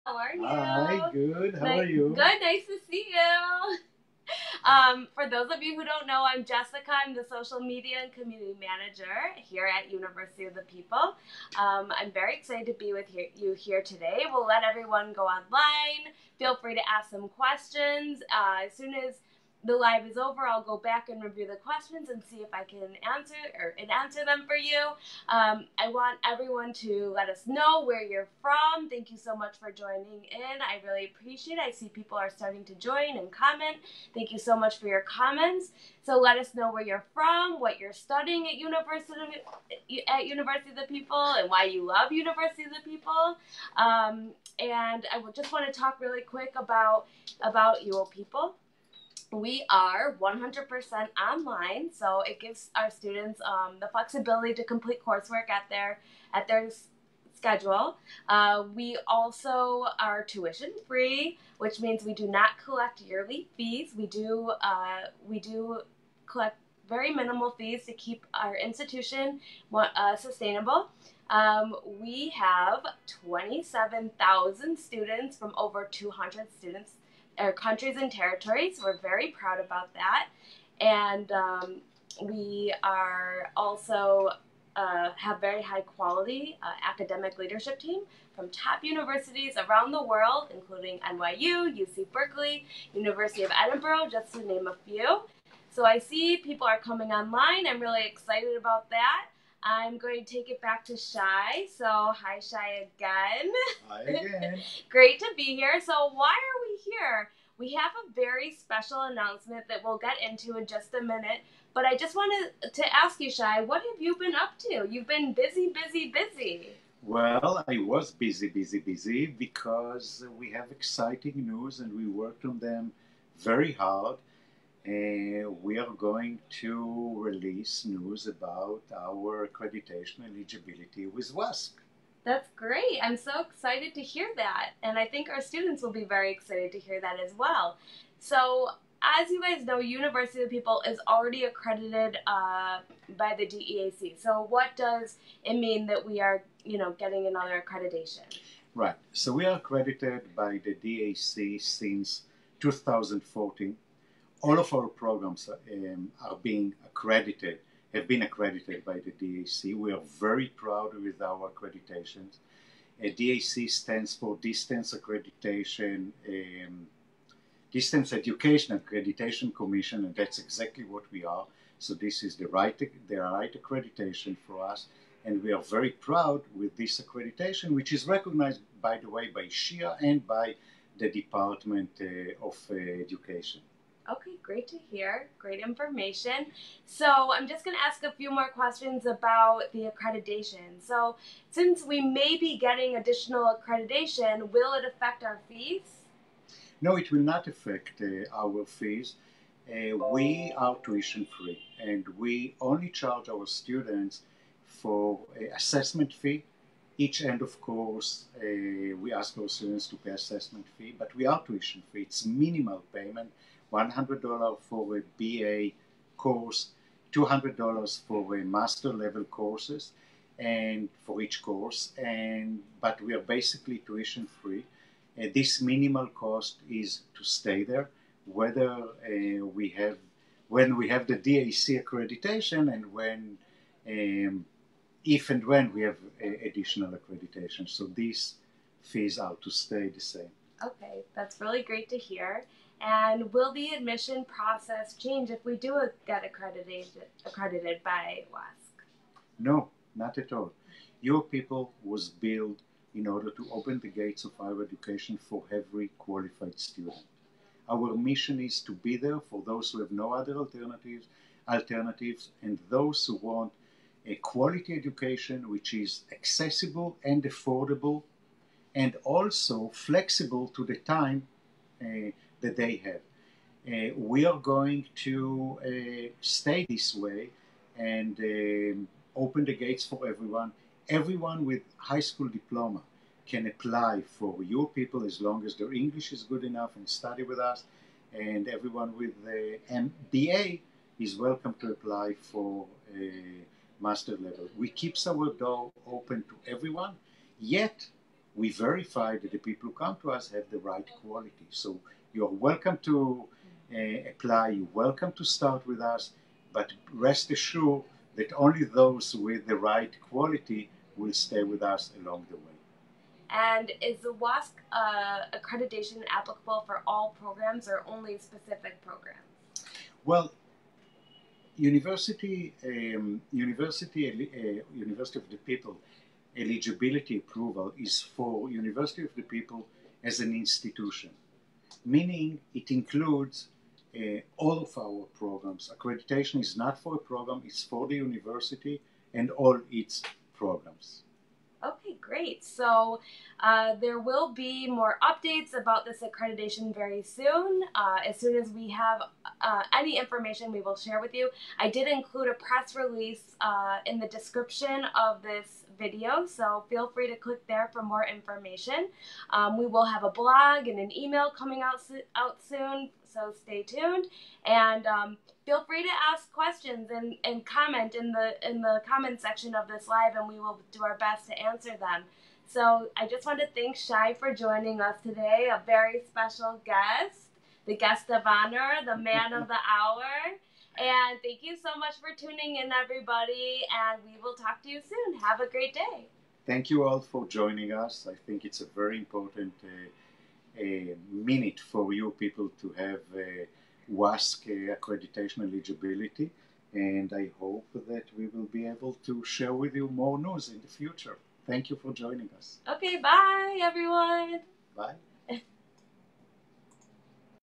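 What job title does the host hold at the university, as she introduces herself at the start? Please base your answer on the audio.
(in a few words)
Social media and community manager.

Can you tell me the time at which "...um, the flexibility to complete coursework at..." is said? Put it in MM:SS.
00:53.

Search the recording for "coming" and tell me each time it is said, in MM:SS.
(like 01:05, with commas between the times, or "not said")
01:36, 06:01.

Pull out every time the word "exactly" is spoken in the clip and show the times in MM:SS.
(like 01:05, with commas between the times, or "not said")
02:50.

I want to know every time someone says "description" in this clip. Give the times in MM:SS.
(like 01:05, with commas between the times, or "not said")
05:54.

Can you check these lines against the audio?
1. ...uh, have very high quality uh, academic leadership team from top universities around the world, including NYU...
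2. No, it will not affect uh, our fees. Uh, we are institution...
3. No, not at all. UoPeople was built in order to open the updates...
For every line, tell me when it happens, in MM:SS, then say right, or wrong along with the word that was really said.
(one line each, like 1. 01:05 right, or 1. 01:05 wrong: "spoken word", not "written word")
1. 01:24 right
2. 03:16 wrong: "tuition", not "institution"
3. 04:09 wrong: "gates", not "updates".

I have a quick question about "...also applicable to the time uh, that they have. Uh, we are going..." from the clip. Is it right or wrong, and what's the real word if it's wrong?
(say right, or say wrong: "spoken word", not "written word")
wrong: "flexible", not "applicable".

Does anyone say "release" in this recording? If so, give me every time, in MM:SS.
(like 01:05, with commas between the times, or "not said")
02:07, 05:52.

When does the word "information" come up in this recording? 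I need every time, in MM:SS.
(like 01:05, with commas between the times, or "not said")
03:05, 05:49, 05:58.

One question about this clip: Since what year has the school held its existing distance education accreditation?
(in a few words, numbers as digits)
2014.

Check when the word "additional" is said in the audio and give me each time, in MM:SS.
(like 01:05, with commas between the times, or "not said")
03:12, 03:56.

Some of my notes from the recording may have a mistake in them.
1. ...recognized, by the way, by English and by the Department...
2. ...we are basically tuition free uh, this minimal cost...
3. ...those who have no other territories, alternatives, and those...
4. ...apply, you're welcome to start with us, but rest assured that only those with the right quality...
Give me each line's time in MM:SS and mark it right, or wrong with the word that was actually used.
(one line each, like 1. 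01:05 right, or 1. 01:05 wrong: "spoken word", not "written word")
1. 02:58 wrong: "CHEA", not "English"
2. 03:43 right
3. 04:19 wrong: "alternatives", not "territories"
4. 05:04 right.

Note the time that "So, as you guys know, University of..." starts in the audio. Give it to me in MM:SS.
02:18.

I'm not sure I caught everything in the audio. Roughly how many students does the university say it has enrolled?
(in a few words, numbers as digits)
27,000.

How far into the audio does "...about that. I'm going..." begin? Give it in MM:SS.
01:38.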